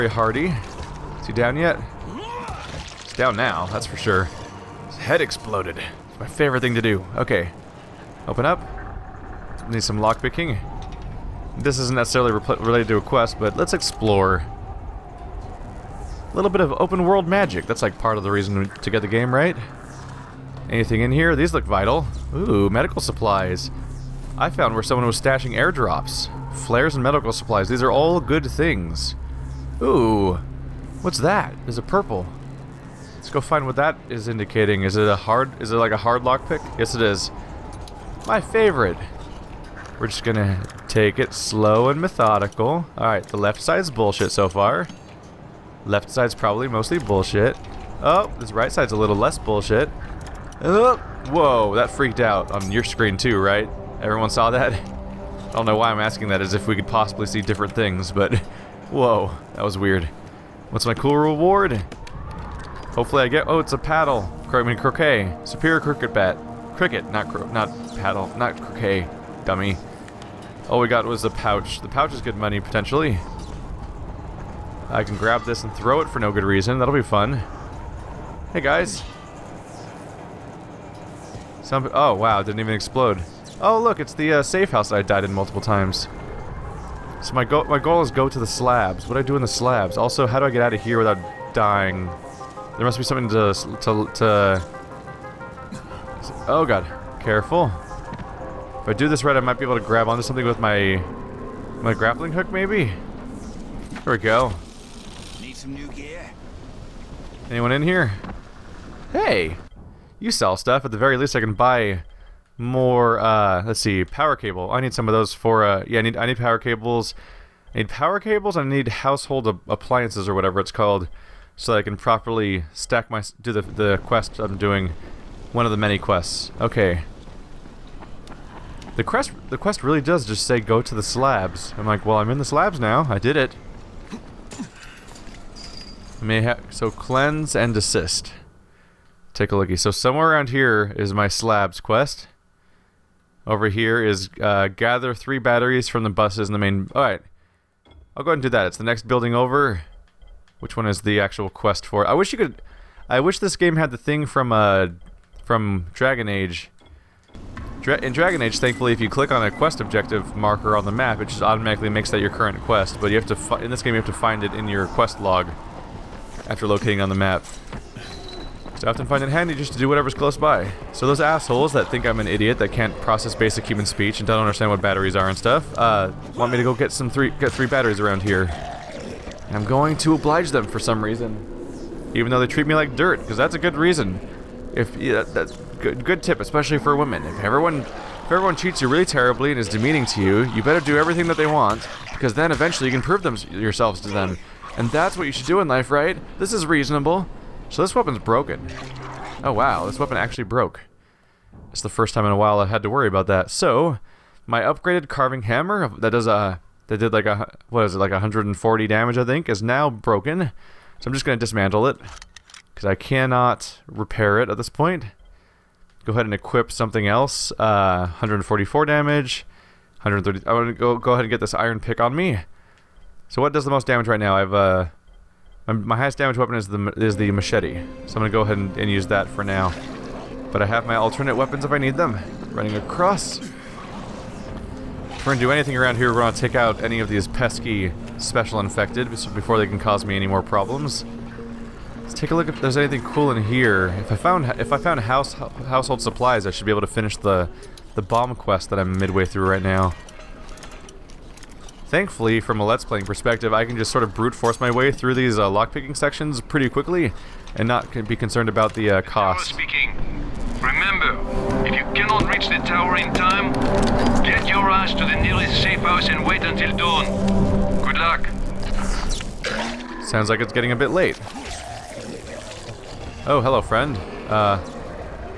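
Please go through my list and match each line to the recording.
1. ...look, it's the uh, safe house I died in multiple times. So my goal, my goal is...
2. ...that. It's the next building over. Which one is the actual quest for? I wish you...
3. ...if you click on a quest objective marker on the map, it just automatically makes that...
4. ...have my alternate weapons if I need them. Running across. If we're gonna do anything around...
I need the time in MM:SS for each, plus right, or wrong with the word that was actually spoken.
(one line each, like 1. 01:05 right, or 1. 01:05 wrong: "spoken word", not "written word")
1. 01:23 right
2. 02:28 right
3. 02:38 right
4. 03:50 right.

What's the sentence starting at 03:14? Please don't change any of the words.
And that's what you should do in life, right?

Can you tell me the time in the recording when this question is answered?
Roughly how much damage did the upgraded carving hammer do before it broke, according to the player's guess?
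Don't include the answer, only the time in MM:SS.
03:28.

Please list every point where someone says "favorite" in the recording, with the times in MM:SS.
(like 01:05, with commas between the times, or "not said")
00:06, 00:38.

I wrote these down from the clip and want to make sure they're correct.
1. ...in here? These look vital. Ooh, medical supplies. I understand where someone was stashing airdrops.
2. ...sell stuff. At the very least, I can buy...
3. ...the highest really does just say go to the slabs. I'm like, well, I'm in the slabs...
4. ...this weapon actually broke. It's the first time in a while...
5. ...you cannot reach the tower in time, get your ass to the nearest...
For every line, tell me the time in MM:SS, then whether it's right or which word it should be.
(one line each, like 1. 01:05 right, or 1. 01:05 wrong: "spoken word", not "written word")
1. 00:21 wrong: "found", not "understand"
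2. 01:50 right
3. 02:09 wrong: "quest", not "highest"
4. 03:19 right
5. 04:21 right.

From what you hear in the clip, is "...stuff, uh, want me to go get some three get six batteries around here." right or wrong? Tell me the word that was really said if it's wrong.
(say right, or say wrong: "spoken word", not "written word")
wrong: "three", not "six".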